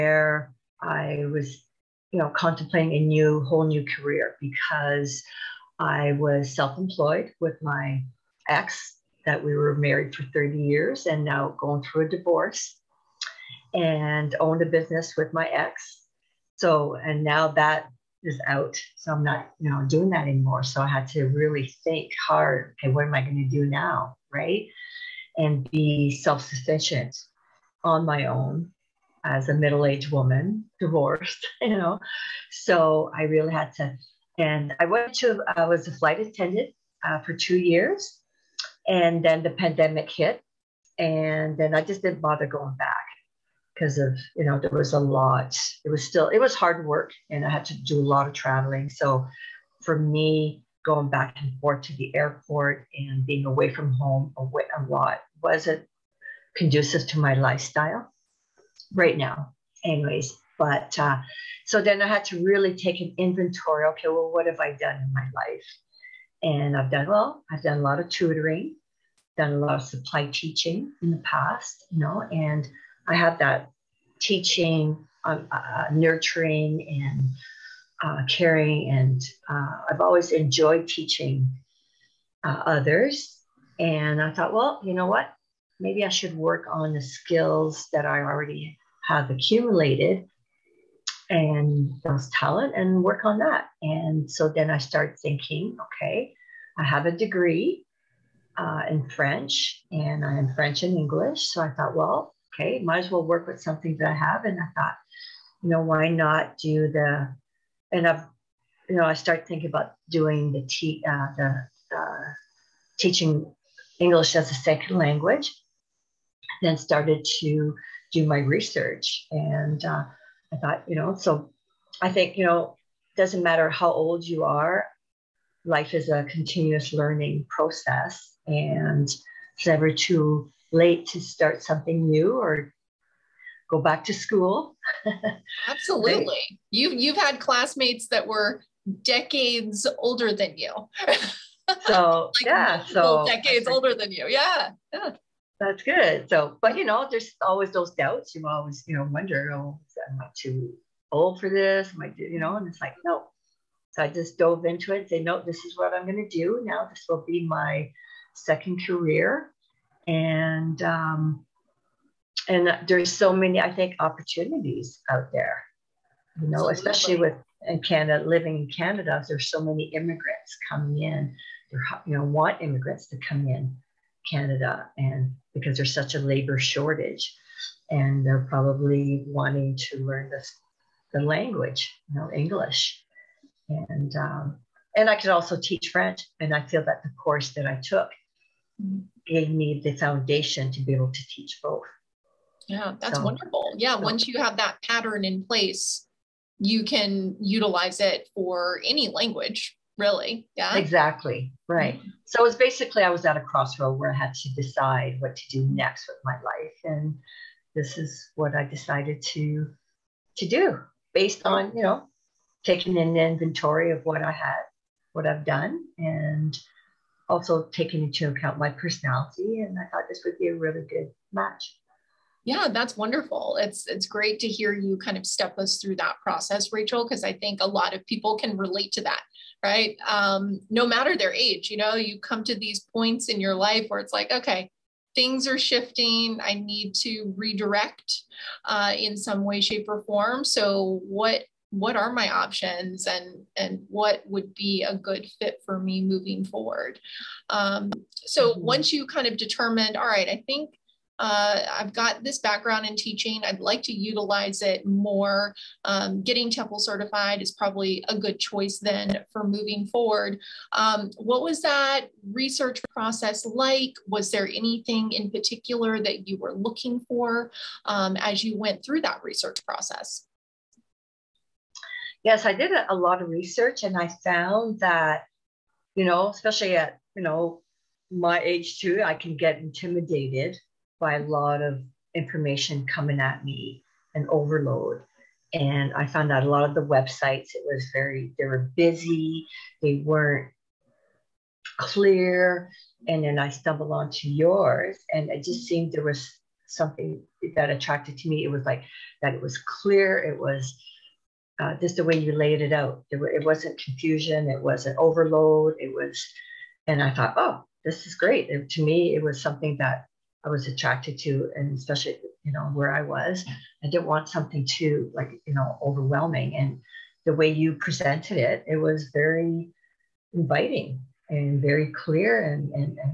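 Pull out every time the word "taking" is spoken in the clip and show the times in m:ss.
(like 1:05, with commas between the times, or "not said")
3:32, 3:37.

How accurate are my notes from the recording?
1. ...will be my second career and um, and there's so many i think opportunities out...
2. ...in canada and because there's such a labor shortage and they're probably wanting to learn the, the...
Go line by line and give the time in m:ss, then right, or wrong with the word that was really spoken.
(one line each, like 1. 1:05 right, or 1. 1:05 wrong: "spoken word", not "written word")
1. 2:37 right
2. 2:53 right.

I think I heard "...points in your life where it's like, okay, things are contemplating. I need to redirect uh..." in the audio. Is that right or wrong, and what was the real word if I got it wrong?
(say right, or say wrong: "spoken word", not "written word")
wrong: "shifting", not "contemplating".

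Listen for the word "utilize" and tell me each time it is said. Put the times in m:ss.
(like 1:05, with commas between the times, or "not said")
3:17, 4:13.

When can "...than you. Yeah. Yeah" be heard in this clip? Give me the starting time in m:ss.
2:23.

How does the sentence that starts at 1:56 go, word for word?
Then started to do my research.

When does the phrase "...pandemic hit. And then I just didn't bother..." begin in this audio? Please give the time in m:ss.
0:39.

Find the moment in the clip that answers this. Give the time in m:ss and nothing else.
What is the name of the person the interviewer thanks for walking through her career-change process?
3:46.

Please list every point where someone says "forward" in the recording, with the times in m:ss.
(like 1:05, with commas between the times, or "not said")
4:06, 4:19.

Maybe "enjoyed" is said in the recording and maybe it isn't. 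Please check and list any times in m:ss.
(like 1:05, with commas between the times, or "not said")
1:20.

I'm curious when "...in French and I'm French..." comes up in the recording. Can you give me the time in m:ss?
1:38.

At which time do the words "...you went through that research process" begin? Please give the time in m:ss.
4:28.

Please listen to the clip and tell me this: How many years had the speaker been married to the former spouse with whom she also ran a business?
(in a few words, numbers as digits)
30.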